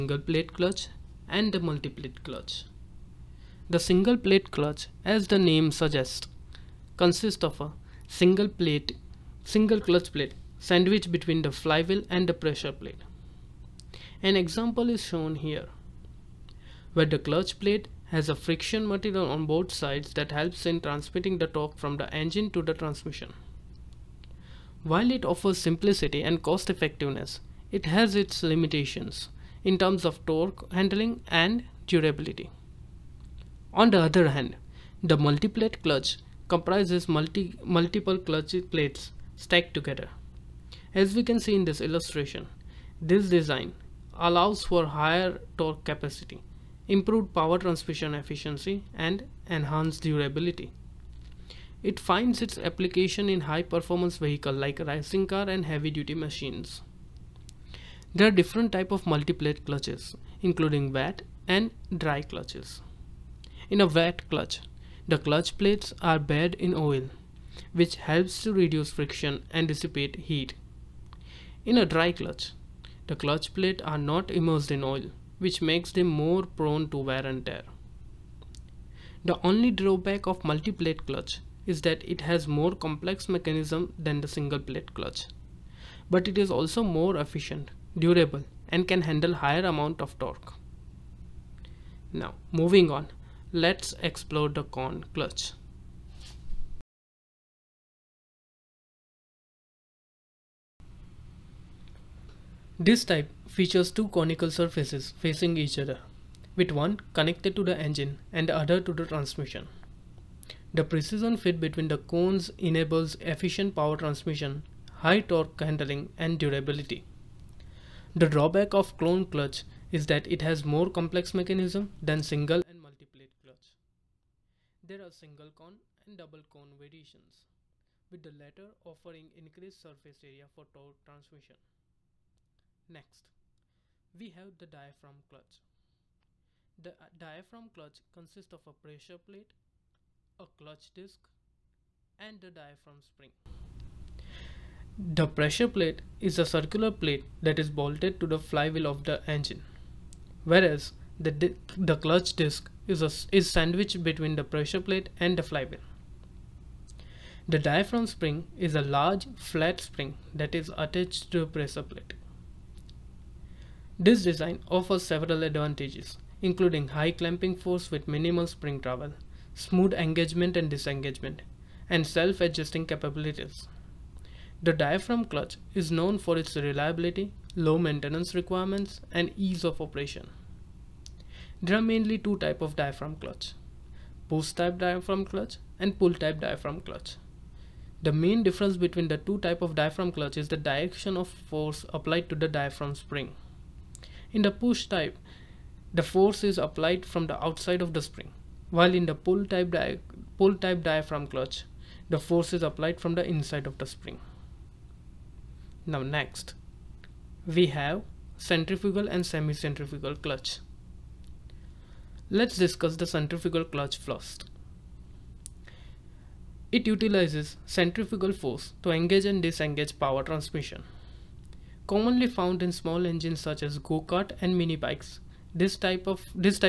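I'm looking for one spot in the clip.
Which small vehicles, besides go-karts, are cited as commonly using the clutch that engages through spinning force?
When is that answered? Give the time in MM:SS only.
03:44.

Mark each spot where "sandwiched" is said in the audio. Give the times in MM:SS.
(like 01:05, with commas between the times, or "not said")
00:10, 02:33.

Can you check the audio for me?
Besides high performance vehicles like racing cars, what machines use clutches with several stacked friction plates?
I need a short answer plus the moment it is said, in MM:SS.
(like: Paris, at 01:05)
heavy duty machines, at 00:55.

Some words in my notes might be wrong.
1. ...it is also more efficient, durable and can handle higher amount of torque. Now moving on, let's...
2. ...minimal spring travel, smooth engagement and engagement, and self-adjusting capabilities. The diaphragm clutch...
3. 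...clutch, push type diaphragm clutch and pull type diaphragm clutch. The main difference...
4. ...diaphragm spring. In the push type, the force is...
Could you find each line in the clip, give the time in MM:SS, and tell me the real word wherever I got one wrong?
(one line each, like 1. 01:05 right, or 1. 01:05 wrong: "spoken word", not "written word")
1. 01:26 right
2. 02:48 wrong: "disengagement", not "engagement"
3. 03:03 right
4. 03:12 right.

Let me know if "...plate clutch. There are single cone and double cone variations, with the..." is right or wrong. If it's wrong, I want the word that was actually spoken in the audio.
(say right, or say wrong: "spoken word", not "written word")
wrong: "multiplate", not "plate".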